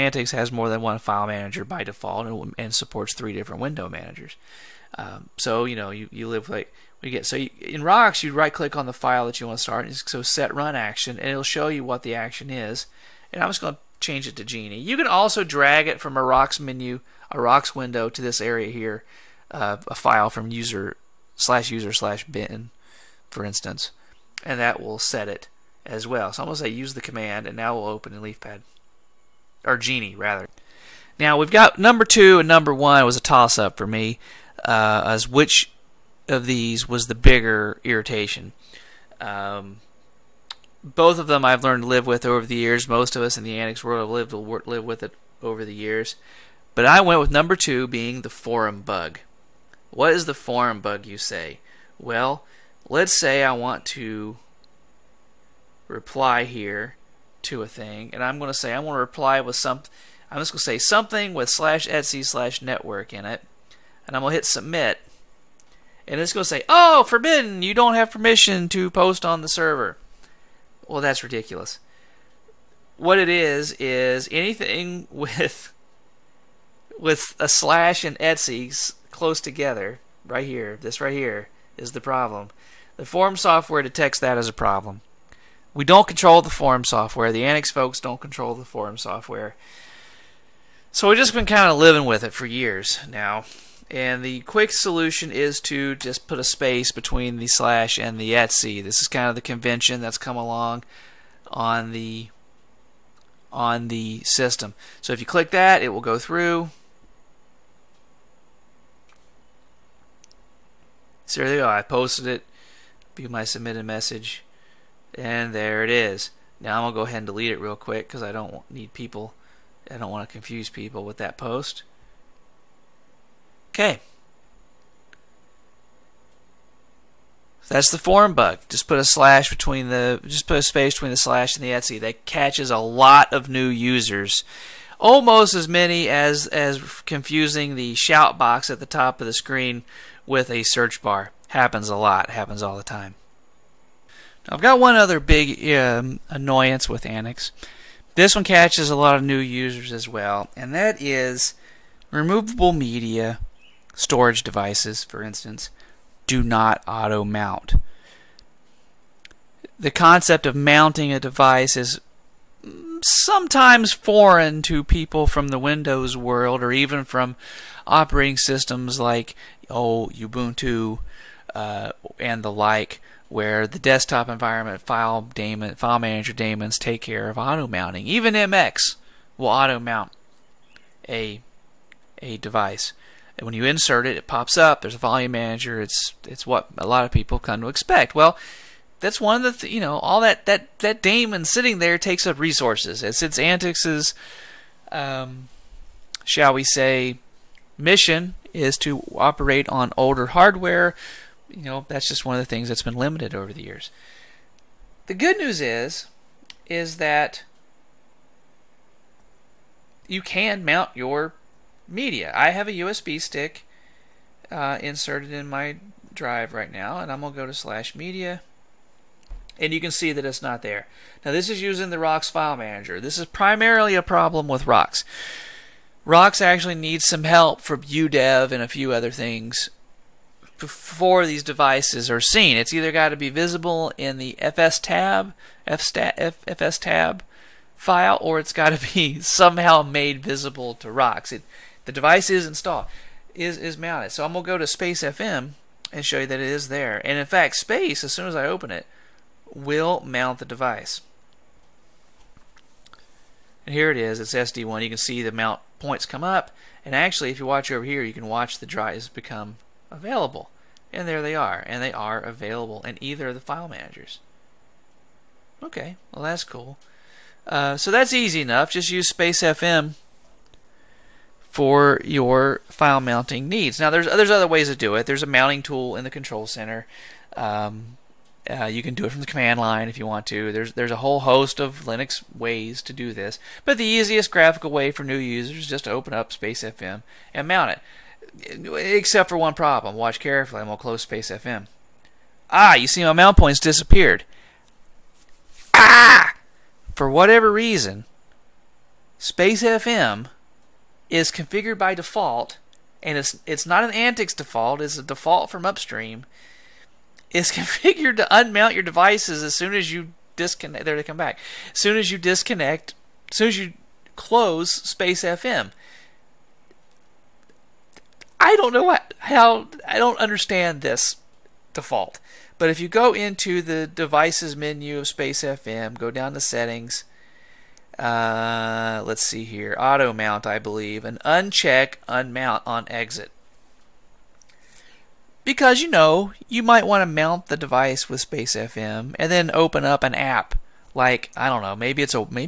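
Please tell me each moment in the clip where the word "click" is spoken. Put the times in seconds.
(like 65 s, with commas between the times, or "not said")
8 s, 105 s.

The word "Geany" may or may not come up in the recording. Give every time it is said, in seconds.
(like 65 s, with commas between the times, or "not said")
14 s, 29 s.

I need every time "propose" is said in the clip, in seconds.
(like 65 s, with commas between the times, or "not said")
not said.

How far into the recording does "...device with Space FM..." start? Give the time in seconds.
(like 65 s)
337 s.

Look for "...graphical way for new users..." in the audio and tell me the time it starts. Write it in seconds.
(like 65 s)
284 s.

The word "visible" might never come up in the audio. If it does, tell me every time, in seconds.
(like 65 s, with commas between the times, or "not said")
233 s, 240 s.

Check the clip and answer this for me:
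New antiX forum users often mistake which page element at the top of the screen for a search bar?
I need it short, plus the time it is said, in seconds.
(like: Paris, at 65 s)
the shout box, at 137 s.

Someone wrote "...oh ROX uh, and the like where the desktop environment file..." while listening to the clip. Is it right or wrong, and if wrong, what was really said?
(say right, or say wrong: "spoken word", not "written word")
wrong: "Ubuntu", not "ROX".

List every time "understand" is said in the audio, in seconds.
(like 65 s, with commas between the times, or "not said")
320 s.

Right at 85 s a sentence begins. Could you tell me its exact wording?
We don't control the form software.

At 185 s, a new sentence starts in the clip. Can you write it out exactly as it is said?
It's it's what a lot of people come to expect.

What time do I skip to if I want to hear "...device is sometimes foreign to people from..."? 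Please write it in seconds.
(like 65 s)
161 s.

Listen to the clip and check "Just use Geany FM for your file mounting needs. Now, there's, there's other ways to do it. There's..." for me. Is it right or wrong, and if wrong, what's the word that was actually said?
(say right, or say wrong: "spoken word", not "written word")
wrong: "Space", not "Geany".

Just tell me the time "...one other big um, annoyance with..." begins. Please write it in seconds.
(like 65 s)
144 s.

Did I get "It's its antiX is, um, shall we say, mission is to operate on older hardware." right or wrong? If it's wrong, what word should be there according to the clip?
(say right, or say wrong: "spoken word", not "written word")
right.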